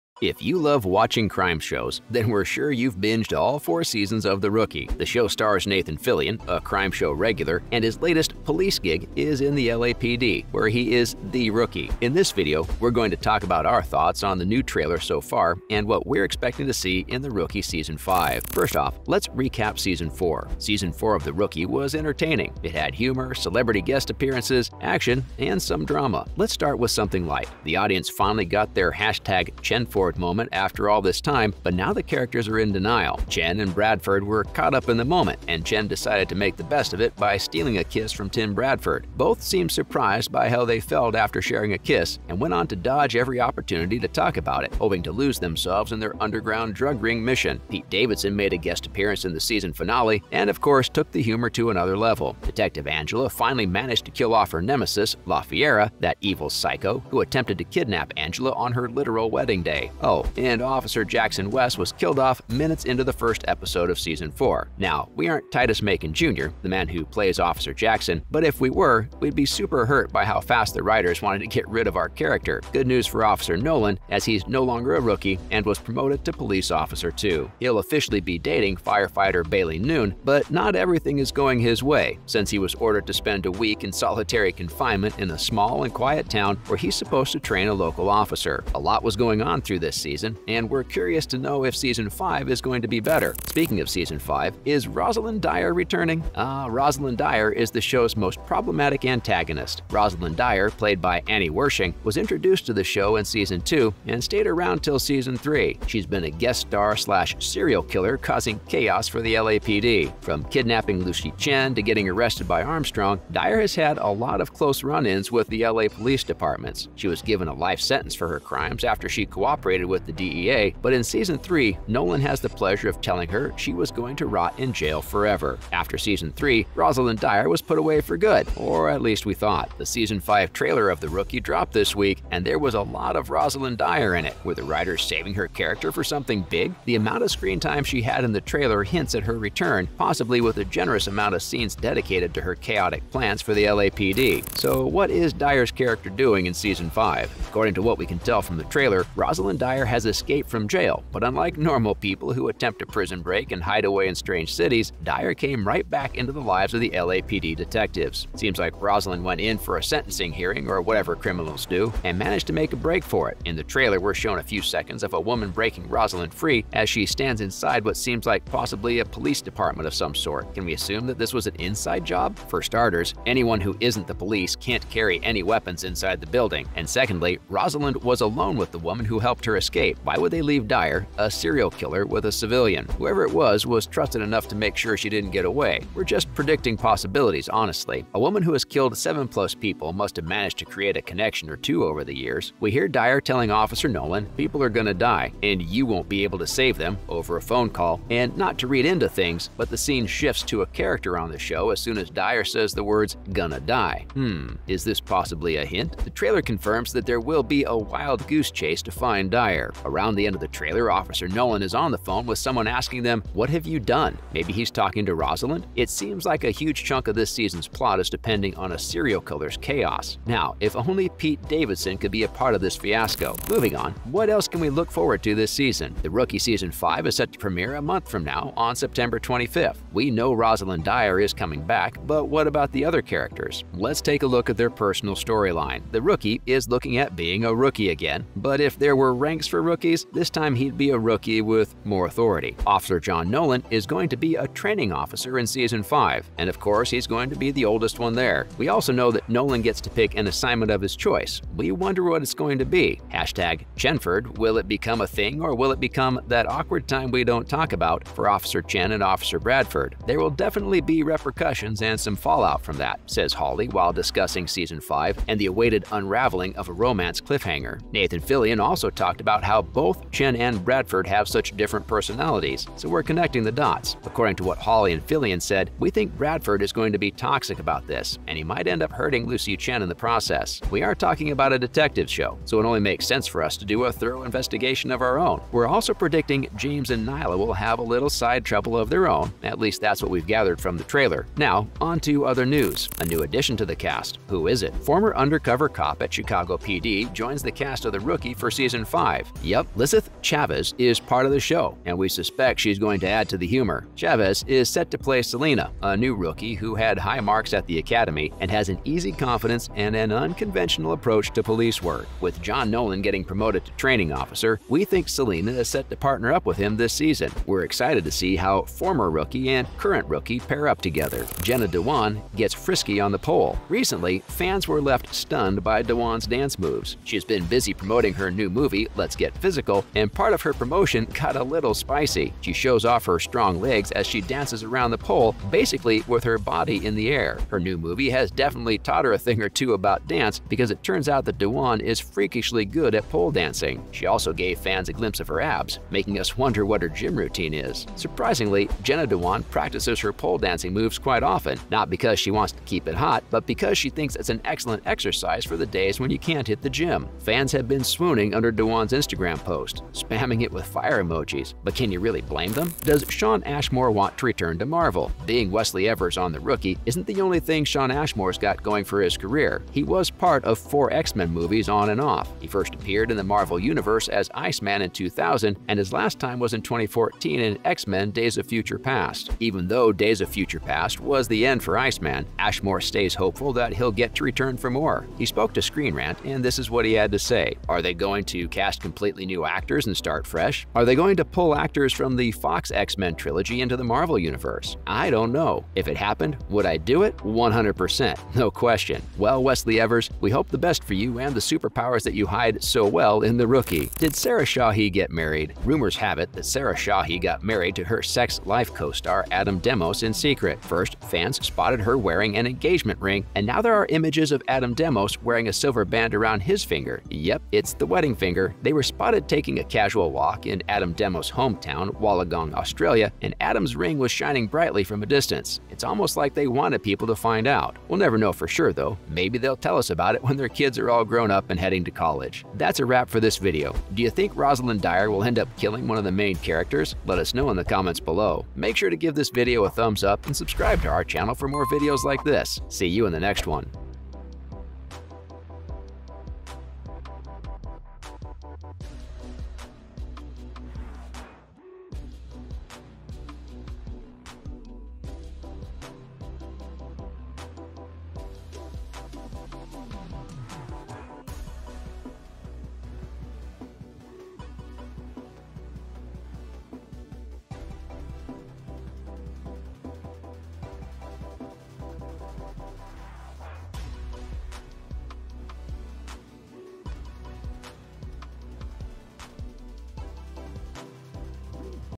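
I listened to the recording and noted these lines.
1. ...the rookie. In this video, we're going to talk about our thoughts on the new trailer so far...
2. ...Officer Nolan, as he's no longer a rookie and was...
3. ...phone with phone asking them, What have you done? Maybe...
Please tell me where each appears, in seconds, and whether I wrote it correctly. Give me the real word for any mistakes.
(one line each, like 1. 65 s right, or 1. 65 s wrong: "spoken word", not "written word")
1. 11 s right
2. 73 s right
3. 211 s wrong: "someone", not "phone".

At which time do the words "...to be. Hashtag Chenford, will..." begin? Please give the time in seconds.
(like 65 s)
252 s.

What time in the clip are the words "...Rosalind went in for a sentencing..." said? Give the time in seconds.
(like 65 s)
158 s.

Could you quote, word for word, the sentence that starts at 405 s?
Rumors have it that Sarah Shahi got married to her Sex Life co-star Adam Demos in secret.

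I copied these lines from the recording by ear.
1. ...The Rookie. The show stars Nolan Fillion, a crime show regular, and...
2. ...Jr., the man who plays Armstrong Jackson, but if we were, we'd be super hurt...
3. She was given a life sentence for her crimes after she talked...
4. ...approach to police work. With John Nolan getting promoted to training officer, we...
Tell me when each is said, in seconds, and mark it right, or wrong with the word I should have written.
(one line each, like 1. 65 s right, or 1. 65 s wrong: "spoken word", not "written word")
1. 4 s wrong: "Nathan", not "Nolan"
2. 66 s wrong: "Officer", not "Armstrong"
3. 116 s wrong: "cooperated", not "talked"
4. 310 s right.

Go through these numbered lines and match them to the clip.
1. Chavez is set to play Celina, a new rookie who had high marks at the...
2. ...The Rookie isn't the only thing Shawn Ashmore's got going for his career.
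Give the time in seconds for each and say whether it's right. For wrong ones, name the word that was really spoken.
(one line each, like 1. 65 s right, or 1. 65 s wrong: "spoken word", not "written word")
1. 303 s right
2. 366 s right.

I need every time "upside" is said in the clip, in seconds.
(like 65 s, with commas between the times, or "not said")
not said.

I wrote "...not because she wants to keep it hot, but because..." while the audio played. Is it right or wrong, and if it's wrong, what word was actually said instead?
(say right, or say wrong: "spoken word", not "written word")
right.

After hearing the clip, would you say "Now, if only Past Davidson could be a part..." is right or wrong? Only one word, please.
wrong.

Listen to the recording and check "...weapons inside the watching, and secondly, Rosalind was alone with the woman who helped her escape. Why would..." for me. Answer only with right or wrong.
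wrong.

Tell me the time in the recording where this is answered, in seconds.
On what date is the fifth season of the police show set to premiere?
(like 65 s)
228 s.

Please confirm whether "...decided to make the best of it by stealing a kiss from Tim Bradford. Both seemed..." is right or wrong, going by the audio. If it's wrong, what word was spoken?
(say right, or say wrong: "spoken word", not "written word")
right.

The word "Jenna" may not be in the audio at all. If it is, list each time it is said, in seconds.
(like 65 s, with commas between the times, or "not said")
321 s, 348 s.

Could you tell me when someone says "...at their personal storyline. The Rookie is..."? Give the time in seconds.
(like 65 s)
234 s.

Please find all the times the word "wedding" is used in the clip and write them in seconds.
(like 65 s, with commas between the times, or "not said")
59 s, 417 s.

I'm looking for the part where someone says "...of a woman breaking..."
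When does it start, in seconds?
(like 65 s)
165 s.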